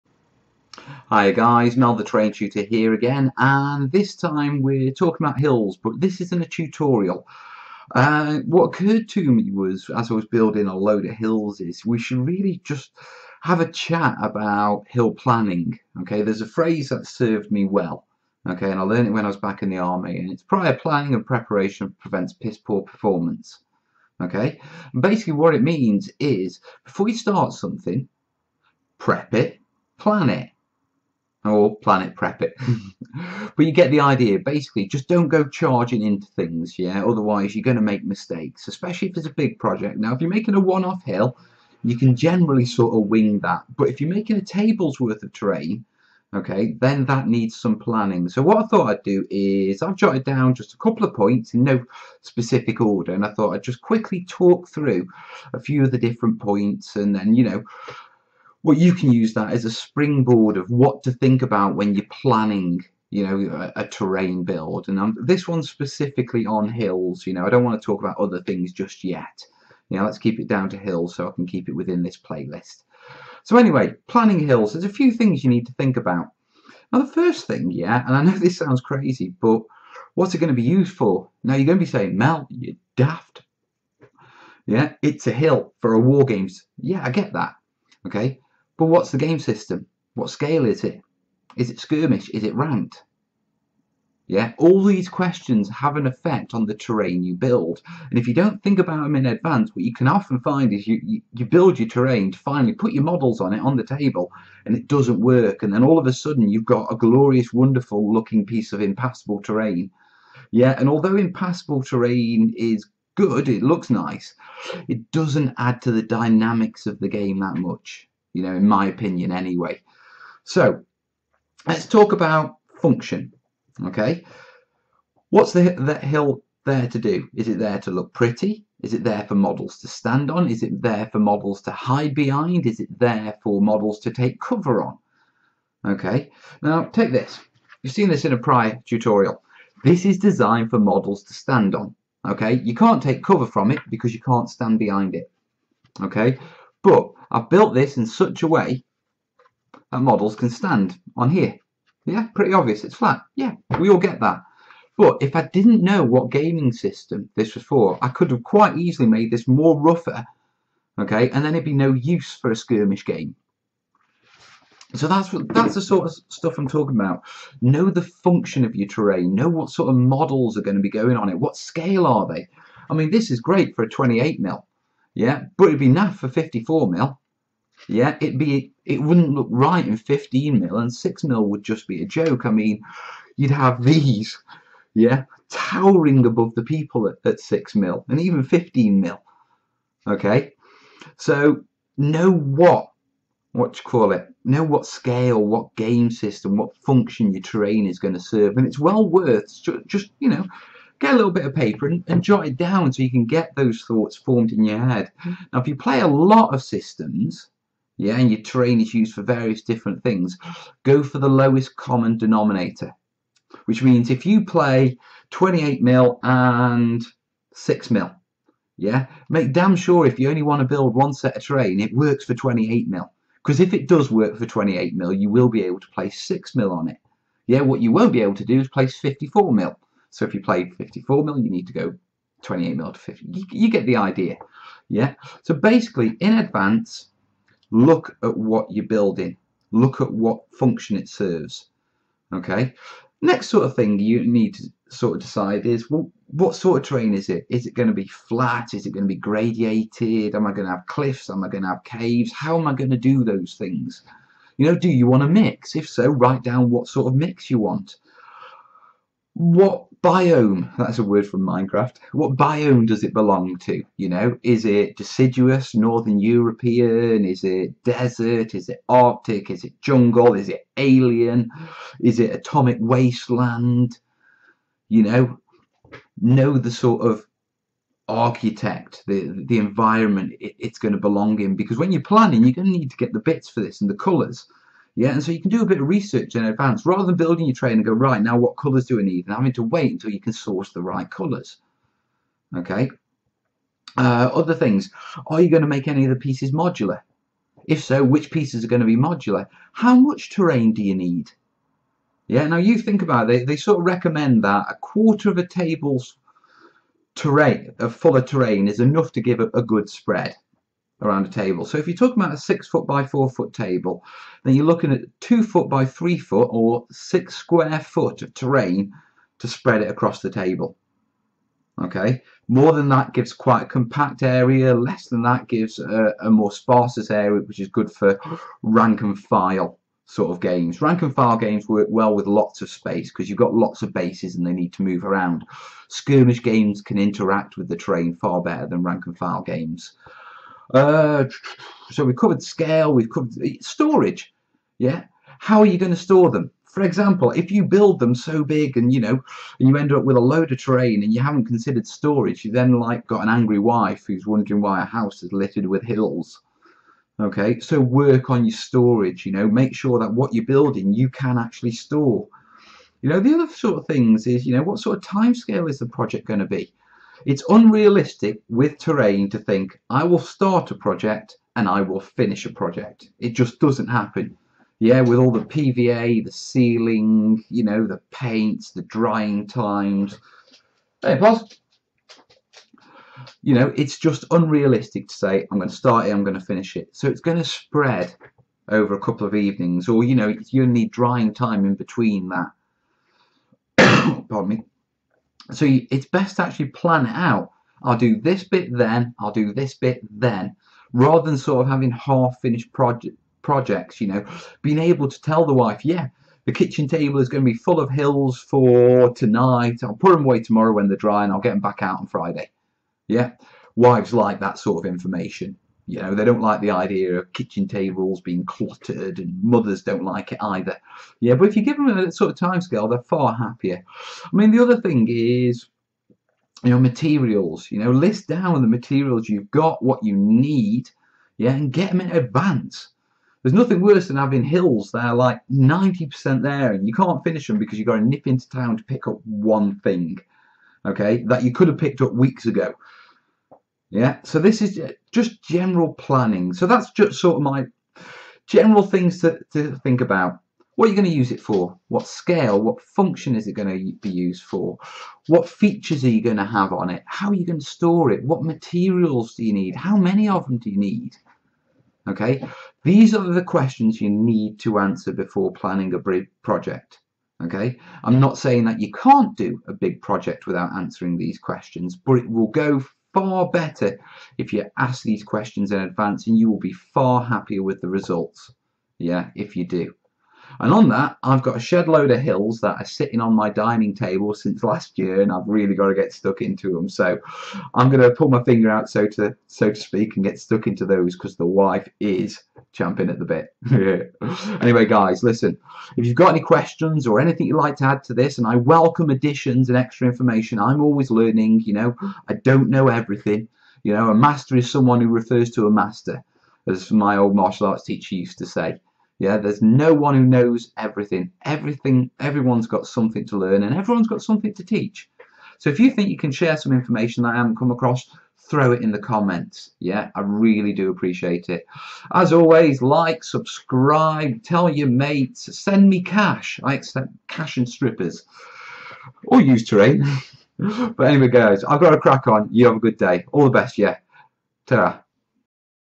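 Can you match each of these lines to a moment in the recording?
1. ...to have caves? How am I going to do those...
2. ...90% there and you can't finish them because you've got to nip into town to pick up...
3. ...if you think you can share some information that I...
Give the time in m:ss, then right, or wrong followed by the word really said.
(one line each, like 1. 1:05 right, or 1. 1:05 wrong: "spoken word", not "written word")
1. 4:11 right
2. 7:15 right
3. 8:35 right.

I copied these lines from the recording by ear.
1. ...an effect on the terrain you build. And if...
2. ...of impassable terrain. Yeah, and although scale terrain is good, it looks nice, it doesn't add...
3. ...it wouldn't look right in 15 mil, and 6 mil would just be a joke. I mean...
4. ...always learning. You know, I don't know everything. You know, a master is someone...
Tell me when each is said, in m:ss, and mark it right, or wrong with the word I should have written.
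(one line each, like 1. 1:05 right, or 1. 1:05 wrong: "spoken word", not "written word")
1. 1:35 right
2. 1:48 wrong: "impassable", not "scale"
3. 2:58 right
4. 8:20 right.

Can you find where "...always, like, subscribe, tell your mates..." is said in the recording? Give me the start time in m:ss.
8:42.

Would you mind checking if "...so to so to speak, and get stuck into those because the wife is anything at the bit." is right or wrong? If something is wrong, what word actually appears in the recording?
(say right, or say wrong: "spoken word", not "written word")
wrong: "champing", not "anything".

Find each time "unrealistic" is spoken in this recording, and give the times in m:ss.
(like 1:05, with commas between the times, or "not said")
6:07, 6:24.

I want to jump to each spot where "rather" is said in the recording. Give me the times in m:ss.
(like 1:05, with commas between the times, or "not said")
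4:46, 6:40.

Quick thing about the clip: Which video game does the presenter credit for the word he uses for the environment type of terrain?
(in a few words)
Minecraft.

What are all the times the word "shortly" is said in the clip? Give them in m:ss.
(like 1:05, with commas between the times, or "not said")
not said.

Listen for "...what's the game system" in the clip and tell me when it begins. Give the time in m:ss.
1:28.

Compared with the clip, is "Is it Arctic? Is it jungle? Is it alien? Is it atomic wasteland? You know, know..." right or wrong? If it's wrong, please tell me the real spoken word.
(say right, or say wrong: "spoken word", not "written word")
right.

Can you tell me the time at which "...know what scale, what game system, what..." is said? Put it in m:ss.
3:14.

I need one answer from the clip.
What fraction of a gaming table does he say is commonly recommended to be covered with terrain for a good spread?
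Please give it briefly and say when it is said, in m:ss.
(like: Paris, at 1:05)
a quarter, at 5:04.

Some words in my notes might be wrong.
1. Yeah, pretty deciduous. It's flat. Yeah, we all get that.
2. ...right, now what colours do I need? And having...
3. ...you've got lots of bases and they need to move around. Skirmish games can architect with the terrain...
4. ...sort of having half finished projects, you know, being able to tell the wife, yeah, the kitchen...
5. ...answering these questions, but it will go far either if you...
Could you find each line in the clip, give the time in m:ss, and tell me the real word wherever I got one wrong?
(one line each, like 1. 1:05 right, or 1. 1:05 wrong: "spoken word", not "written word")
1. 2:32 wrong: "obvious", not "deciduous"
2. 4:47 right
3. 5:33 wrong: "interact", not "architect"
4. 6:41 right
5. 7:50 wrong: "better", not "either".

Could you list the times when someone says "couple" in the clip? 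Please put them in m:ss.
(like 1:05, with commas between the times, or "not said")
0:50, 6:28.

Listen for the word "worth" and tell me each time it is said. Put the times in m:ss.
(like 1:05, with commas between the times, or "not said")
0:44, 3:19.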